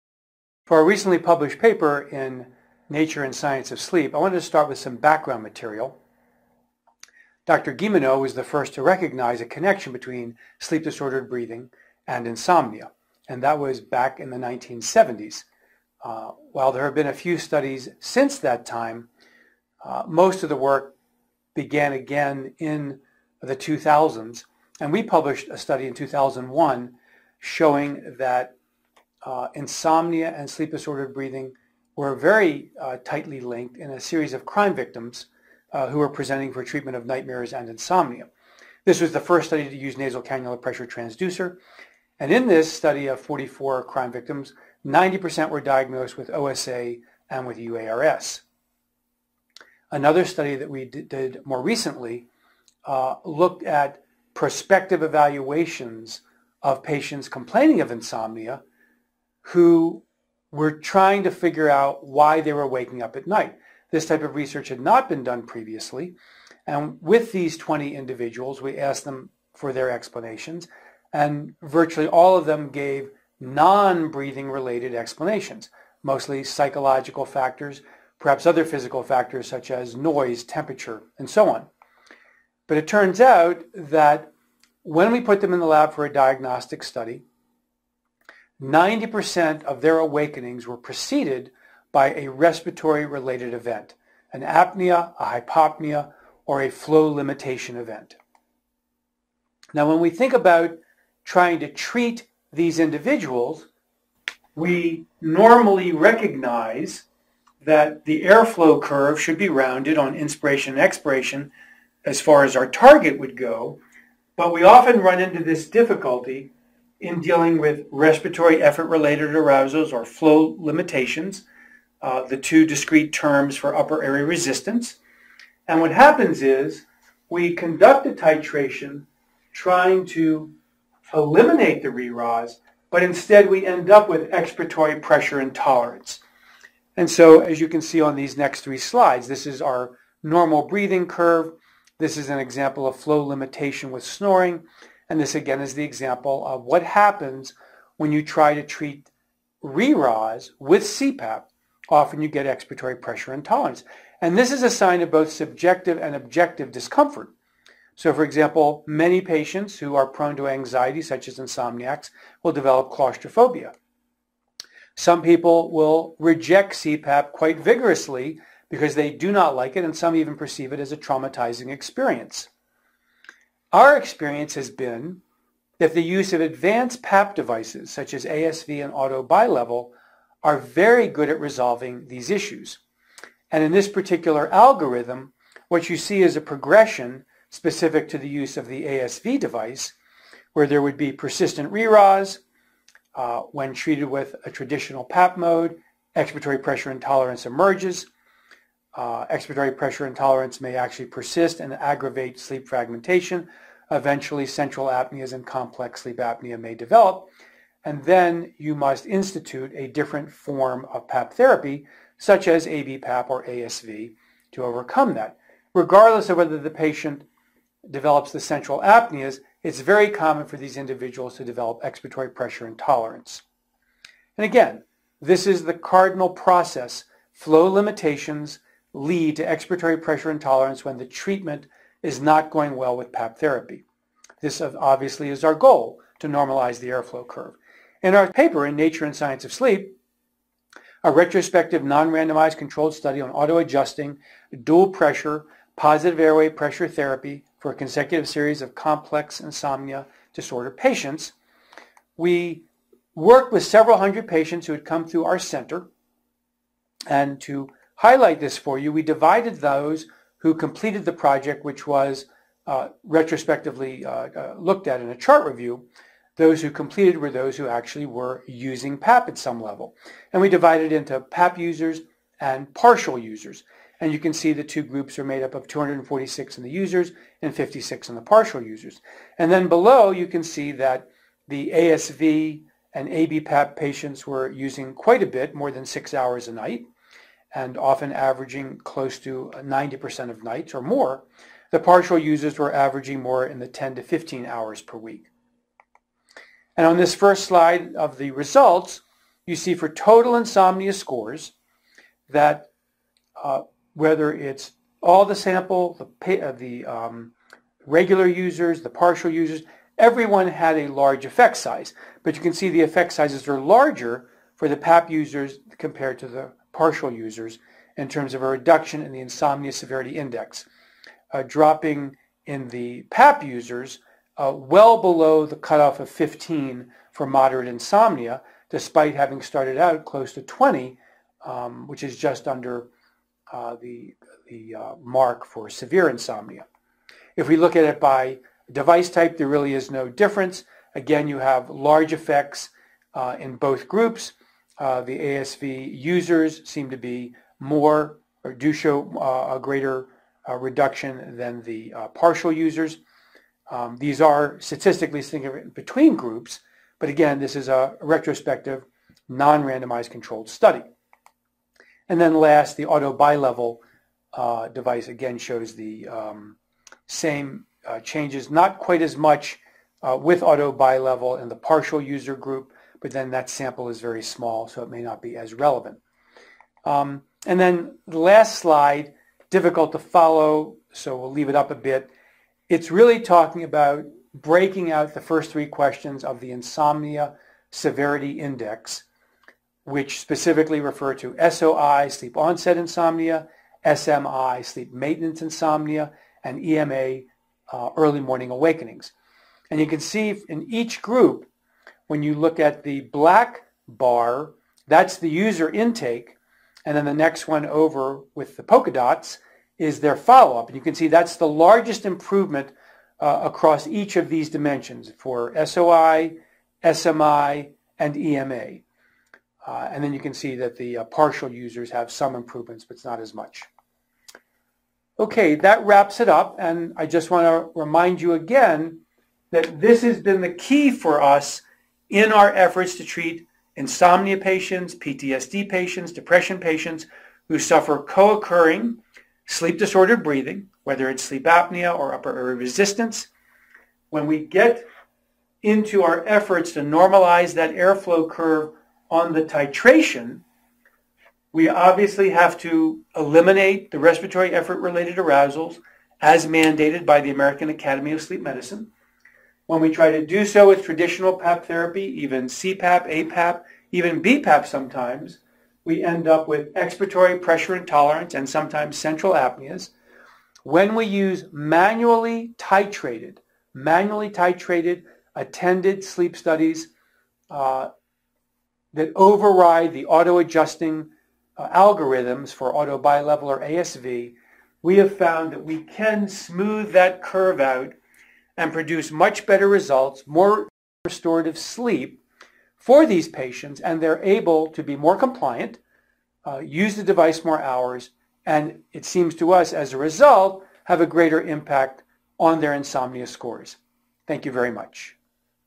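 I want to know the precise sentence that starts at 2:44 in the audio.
Some people will reject CPAP quite vigorously because they do not like it, and some even perceive it as a traumatizing experience.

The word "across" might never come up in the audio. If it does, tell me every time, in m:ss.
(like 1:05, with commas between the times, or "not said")
6:53.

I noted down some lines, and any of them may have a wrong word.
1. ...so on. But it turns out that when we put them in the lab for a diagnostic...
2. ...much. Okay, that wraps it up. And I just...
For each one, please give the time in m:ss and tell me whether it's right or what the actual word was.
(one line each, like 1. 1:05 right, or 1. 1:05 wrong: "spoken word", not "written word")
1. 1:21 right
2. 7:03 right.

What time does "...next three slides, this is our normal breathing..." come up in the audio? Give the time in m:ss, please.
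2:18.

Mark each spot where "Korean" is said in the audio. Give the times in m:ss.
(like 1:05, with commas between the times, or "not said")
not said.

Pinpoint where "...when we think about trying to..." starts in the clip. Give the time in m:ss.
1:39.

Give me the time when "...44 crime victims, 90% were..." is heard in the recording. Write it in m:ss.
0:43.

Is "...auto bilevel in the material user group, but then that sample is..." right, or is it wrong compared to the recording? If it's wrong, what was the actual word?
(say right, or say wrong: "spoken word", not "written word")
wrong: "partial", not "material".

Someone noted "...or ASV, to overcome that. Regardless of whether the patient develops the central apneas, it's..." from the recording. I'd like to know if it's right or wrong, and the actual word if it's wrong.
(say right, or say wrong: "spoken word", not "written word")
right.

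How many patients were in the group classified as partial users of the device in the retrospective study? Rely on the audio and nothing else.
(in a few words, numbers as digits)
56.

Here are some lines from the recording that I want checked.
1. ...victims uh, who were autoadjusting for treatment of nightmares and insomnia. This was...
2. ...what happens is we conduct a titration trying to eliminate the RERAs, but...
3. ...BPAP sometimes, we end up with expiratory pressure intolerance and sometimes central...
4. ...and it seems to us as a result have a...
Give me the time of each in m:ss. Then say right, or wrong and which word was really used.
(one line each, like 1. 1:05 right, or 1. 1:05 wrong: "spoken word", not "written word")
1. 0:34 wrong: "presenting", not "autoadjusting"
2. 2:05 right
3. 7:44 right
4. 8:18 right.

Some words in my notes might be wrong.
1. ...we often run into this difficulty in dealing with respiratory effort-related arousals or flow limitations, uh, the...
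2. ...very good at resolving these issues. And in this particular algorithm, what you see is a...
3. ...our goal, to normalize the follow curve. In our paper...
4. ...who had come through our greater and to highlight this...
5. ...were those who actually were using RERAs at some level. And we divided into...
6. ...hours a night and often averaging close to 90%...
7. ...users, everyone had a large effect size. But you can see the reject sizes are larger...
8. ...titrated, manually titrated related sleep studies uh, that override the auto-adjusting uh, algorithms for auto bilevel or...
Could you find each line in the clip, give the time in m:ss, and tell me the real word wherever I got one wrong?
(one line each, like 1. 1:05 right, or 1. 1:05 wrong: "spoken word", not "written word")
1. 1:54 right
2. 3:00 right
3. 3:55 wrong: "airflow", not "follow"
4. 4:14 wrong: "center", not "greater"
5. 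4:27 wrong: "PAP", not "RERAs"
6. 4:46 right
7. 5:09 wrong: "effect", not "reject"
8. 7:52 wrong: "attended", not "related".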